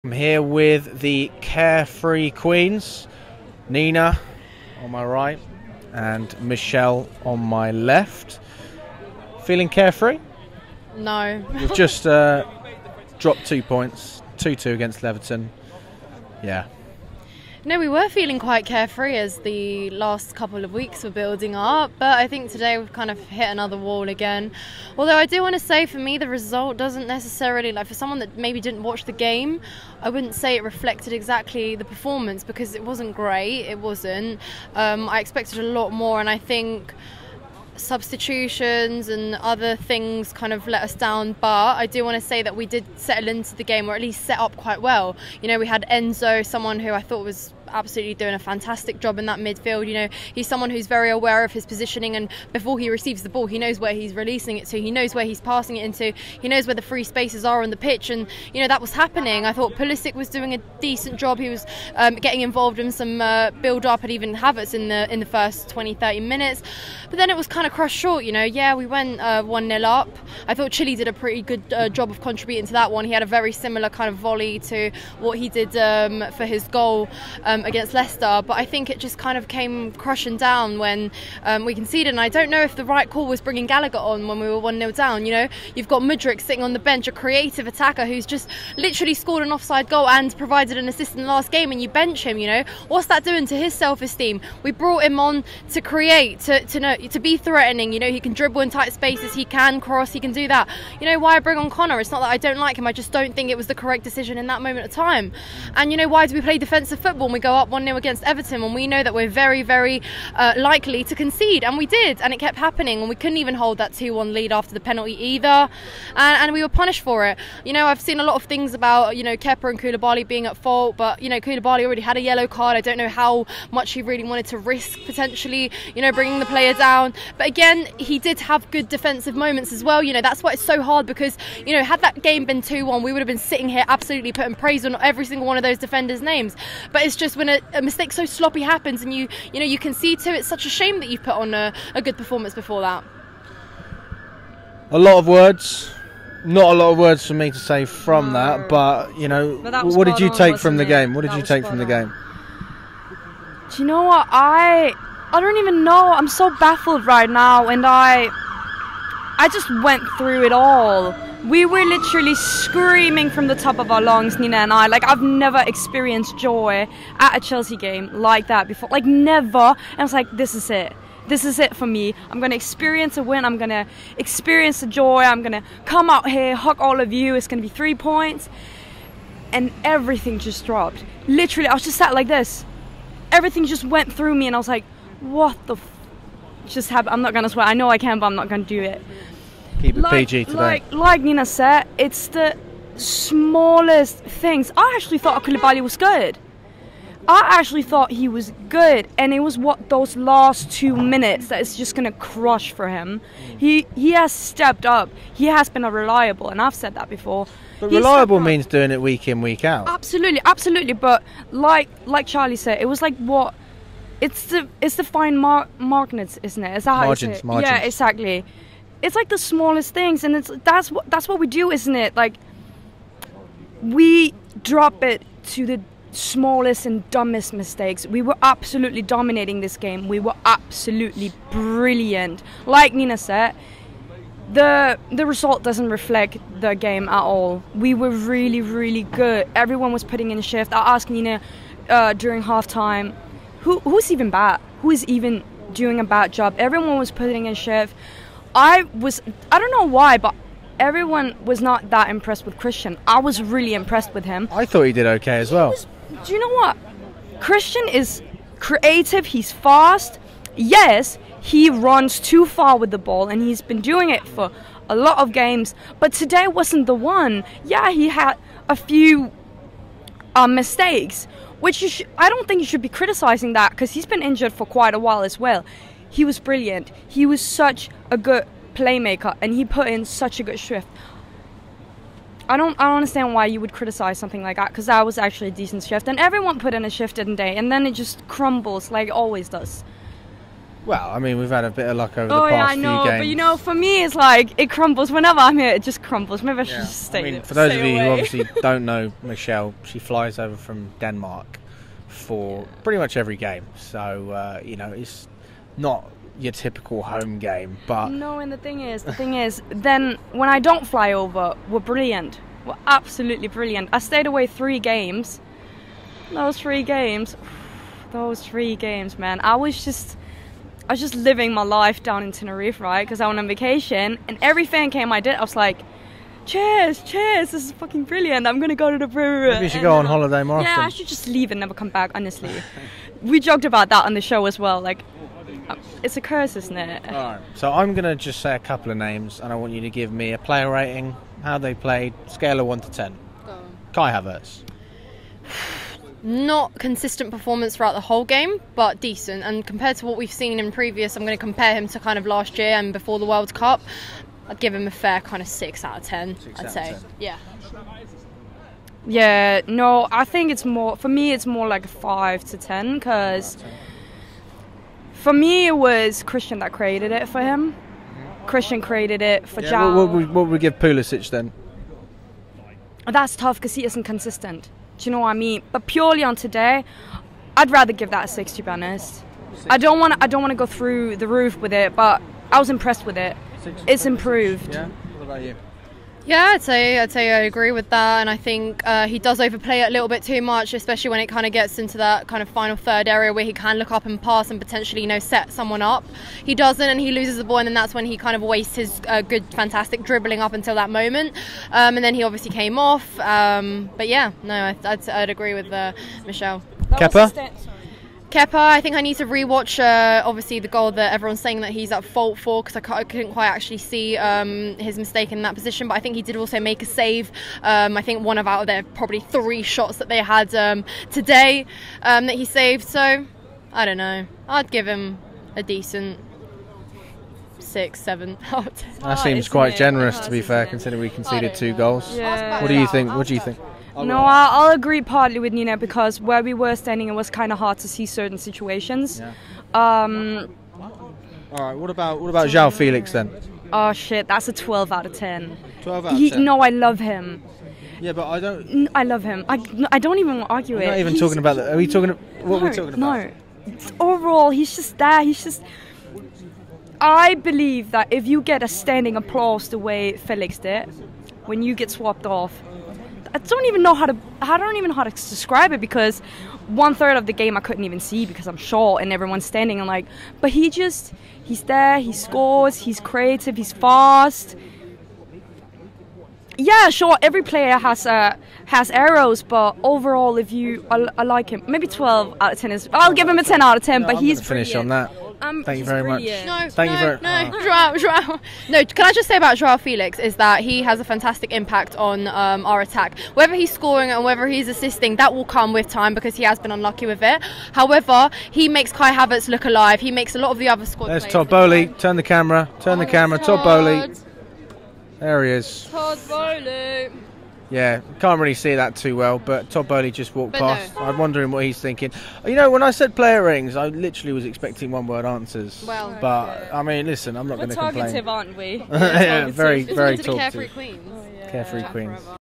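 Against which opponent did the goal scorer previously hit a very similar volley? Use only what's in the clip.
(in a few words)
Leicester.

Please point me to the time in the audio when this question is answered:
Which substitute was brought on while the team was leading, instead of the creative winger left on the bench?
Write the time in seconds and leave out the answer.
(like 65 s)
83 s.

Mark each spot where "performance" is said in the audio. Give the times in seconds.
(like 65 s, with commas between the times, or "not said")
31 s, 142 s, 347 s.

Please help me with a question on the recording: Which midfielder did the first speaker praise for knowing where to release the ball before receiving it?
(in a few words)
Enzo.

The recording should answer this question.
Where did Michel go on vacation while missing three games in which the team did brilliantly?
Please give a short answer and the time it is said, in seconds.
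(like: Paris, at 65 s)
Tenerife, at 322 s.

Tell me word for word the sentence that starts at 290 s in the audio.
Well, I mean, we've had a bit of luck over oh, the past yeah, I know, games.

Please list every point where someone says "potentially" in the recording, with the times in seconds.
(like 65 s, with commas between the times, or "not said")
125 s, 394 s.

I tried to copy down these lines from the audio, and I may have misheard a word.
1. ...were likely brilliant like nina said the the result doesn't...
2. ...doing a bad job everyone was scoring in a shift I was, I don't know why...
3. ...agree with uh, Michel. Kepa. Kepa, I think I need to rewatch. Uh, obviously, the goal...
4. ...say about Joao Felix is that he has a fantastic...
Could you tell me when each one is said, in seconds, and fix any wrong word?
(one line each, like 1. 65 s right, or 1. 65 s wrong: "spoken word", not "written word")
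1. 230 s wrong: "absolutely", not "likely"
2. 245 s wrong: "putting", not "scoring"
3. 405 s right
4. 489 s right.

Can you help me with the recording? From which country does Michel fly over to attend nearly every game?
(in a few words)
Denmark.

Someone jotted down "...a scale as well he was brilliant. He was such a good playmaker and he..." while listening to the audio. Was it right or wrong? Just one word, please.
wrong.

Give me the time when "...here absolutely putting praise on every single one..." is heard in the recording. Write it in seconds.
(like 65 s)
133 s.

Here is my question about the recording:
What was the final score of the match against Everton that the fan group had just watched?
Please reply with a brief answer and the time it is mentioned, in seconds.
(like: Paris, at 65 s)
2-2, at 14 s.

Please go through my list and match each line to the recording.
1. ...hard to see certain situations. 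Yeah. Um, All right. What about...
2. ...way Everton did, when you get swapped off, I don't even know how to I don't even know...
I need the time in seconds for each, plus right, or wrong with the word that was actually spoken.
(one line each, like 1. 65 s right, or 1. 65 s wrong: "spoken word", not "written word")
1. 437 s right
2. 459 s wrong: "Felix", not "Everton".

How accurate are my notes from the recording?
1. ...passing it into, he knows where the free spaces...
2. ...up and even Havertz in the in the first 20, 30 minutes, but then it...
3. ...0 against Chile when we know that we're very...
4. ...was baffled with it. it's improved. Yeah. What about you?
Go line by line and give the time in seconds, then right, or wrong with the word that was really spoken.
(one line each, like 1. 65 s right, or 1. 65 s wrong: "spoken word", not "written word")
1. 55 s right
2. 63 s right
3. 107 s wrong: "Everton", not "Chile"
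4. 382 s wrong: "impressed", not "baffled".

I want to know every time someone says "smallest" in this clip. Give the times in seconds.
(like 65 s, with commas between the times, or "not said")
192 s, 219 s, 226 s.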